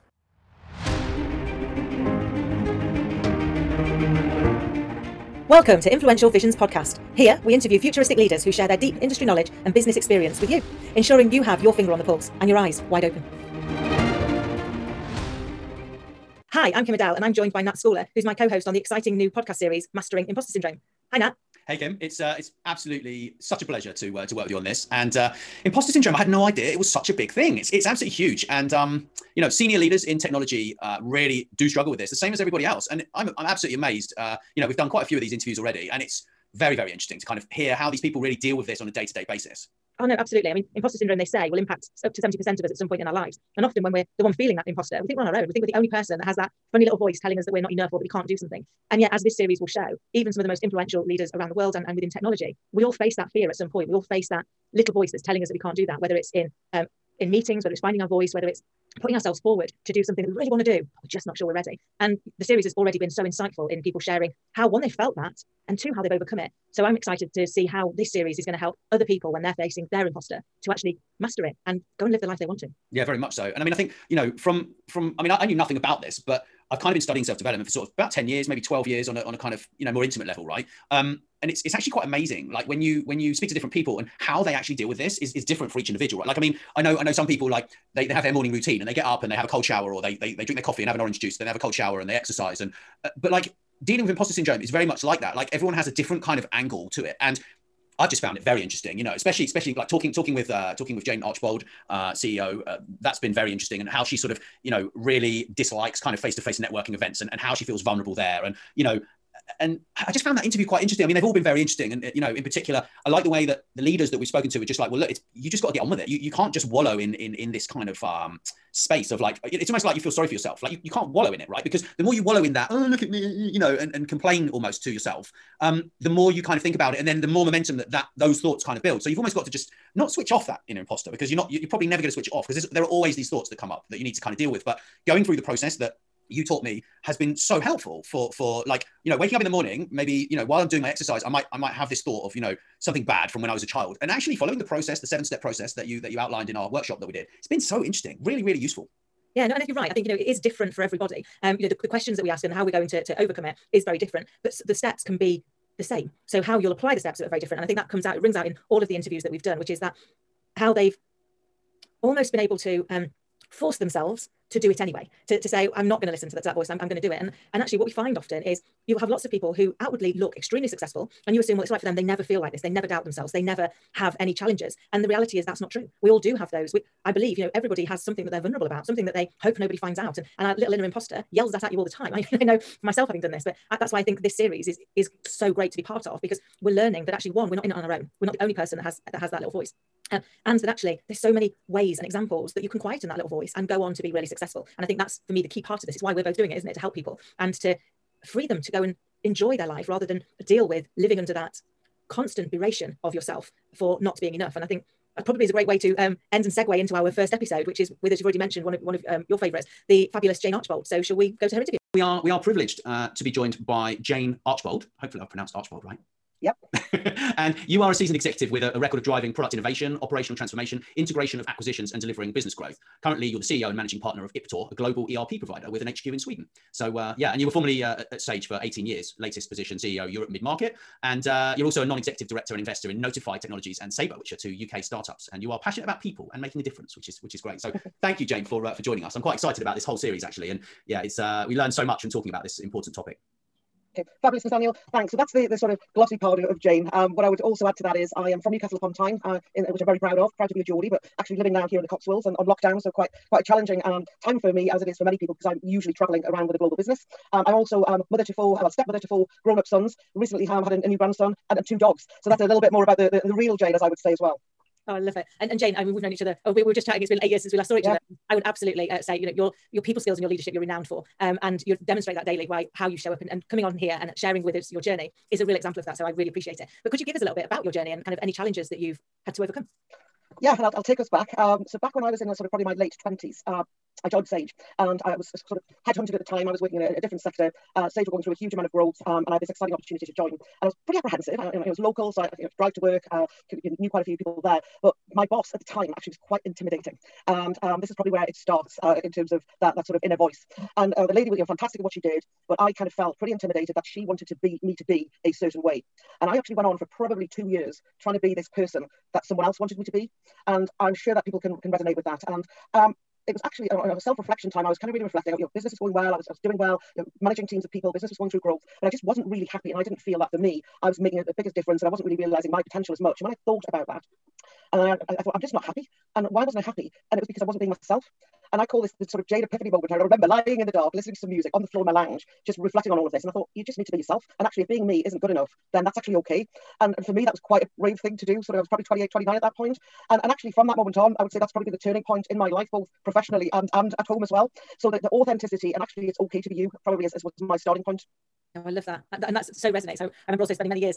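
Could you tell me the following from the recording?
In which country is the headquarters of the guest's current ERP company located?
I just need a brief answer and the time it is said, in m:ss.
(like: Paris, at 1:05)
Sweden, at 3:46.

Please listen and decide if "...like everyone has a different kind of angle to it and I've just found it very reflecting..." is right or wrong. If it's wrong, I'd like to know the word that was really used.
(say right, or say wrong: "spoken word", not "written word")
wrong: "interesting", not "reflecting".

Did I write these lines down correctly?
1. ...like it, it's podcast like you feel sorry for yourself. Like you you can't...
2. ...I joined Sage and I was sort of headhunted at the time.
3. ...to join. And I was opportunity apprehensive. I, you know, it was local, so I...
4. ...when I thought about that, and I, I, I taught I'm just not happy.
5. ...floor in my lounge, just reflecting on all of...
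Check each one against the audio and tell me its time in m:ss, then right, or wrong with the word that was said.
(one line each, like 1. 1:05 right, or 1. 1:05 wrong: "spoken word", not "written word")
1. 1:59 wrong: "almost", not "podcast"
2. 4:44 right
3. 4:50 wrong: "pretty", not "opportunity"
4. 5:23 wrong: "thought", not "taught"
5. 5:31 right.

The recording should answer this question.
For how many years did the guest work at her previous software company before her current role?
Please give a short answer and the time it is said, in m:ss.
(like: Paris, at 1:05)
18, at 3:48.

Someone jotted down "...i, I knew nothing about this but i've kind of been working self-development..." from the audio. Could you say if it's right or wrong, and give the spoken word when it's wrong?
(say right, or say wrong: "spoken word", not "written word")
wrong: "studying", not "working".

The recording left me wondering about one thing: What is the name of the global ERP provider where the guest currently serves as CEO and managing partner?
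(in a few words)
Iptor.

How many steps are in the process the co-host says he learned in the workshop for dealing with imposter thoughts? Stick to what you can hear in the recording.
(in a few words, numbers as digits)
7.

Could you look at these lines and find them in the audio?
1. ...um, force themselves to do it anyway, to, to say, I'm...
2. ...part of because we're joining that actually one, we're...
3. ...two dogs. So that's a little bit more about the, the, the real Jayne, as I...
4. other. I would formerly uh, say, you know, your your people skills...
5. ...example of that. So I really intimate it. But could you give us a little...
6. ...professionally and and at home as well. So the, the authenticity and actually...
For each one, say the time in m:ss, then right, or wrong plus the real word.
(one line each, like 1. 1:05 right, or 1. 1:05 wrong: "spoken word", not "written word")
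1. 2:42 right
2. 3:05 wrong: "learning", not "joining"
3. 4:21 right
4. 4:27 wrong: "absolutely", not "formerly"
5. 4:35 wrong: "appreciate", not "intimate"
6. 5:43 right.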